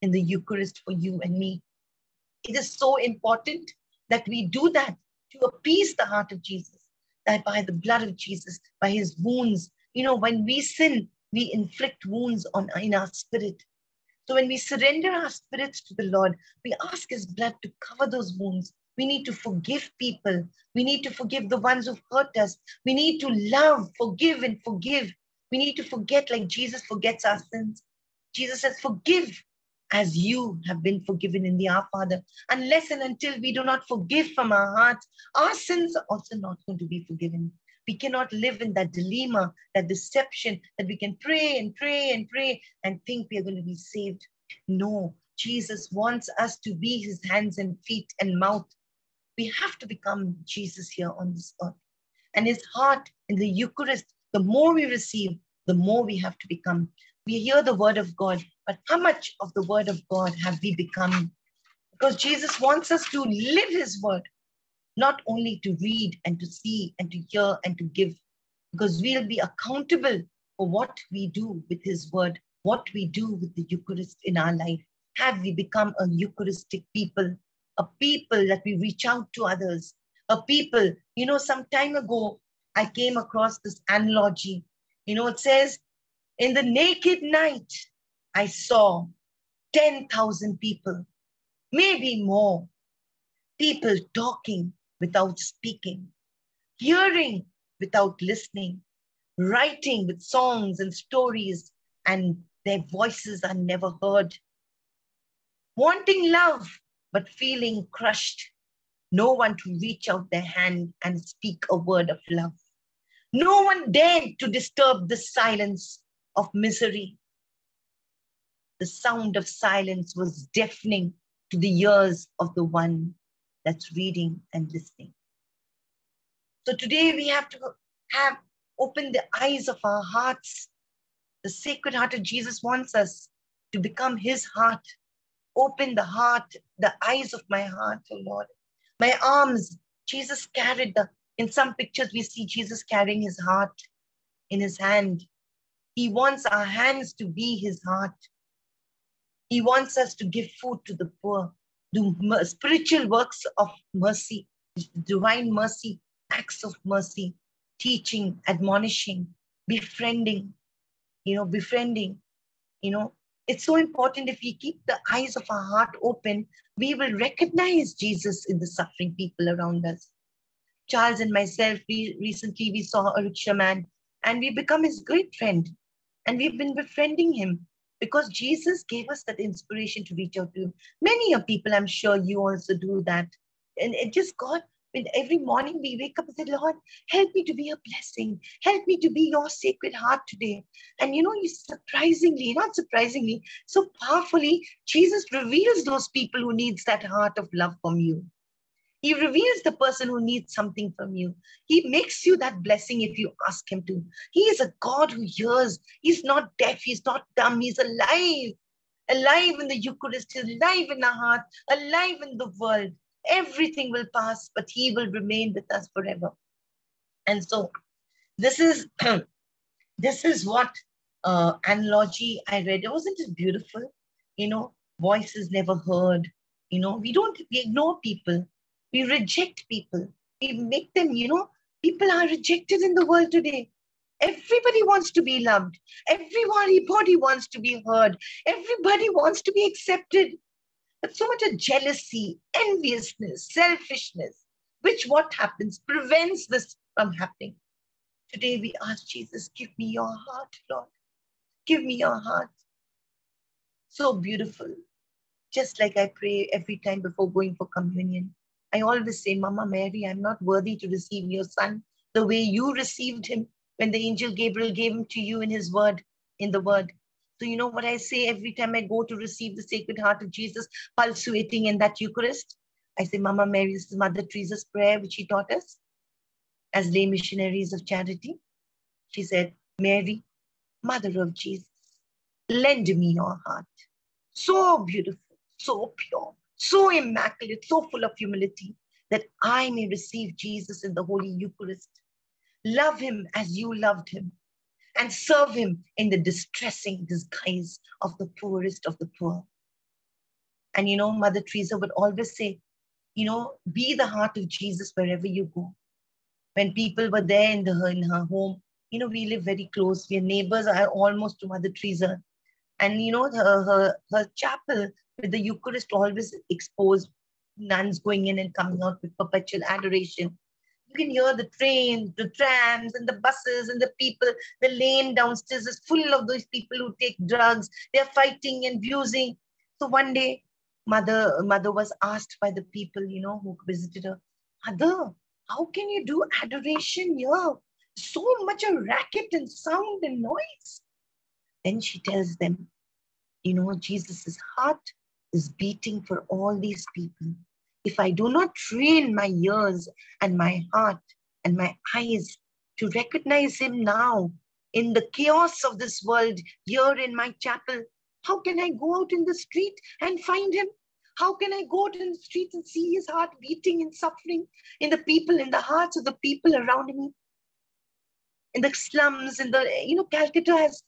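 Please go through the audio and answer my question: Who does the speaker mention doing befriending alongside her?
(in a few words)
Charles.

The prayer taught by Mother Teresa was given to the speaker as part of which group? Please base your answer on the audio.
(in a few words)
lay missionaries of charity.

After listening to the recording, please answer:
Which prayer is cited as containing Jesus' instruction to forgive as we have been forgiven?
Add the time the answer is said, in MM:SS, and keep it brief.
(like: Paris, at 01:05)
The Our Father, at 00:31.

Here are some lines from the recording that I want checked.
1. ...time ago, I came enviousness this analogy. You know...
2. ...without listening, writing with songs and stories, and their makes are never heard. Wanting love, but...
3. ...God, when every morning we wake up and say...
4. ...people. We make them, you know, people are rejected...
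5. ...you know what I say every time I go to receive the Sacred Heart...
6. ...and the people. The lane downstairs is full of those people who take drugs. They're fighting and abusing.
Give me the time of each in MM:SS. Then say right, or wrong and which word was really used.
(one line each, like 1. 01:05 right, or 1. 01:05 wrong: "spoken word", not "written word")
1. 01:21 wrong: "across", not "enviousness"
2. 01:37 wrong: "voices", not "makes"
3. 03:04 right
4. 03:49 right
5. 04:27 right
6. 05:23 right.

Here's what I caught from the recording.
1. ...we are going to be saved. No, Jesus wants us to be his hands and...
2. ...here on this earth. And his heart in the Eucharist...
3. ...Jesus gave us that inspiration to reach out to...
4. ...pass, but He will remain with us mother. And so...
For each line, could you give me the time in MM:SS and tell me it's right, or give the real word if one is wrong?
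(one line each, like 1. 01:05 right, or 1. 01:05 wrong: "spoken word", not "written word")
1. 00:43 right
2. 00:50 right
3. 02:58 right
4. 03:34 wrong: "forever", not "mother".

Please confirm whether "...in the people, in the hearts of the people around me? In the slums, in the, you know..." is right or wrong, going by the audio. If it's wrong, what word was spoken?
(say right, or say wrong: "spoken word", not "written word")
right.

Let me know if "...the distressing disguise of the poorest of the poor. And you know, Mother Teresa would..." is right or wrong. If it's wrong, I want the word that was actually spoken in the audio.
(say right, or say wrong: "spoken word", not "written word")
right.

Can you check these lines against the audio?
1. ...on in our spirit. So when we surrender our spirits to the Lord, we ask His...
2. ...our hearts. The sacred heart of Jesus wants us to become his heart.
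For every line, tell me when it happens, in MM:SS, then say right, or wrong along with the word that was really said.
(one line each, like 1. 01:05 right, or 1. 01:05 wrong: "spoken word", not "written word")
1. 00:12 right
2. 02:09 right.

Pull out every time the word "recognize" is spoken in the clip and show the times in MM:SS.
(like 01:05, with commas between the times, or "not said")
02:47, 05:52.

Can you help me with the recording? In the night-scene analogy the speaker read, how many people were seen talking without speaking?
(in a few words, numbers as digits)
10,000.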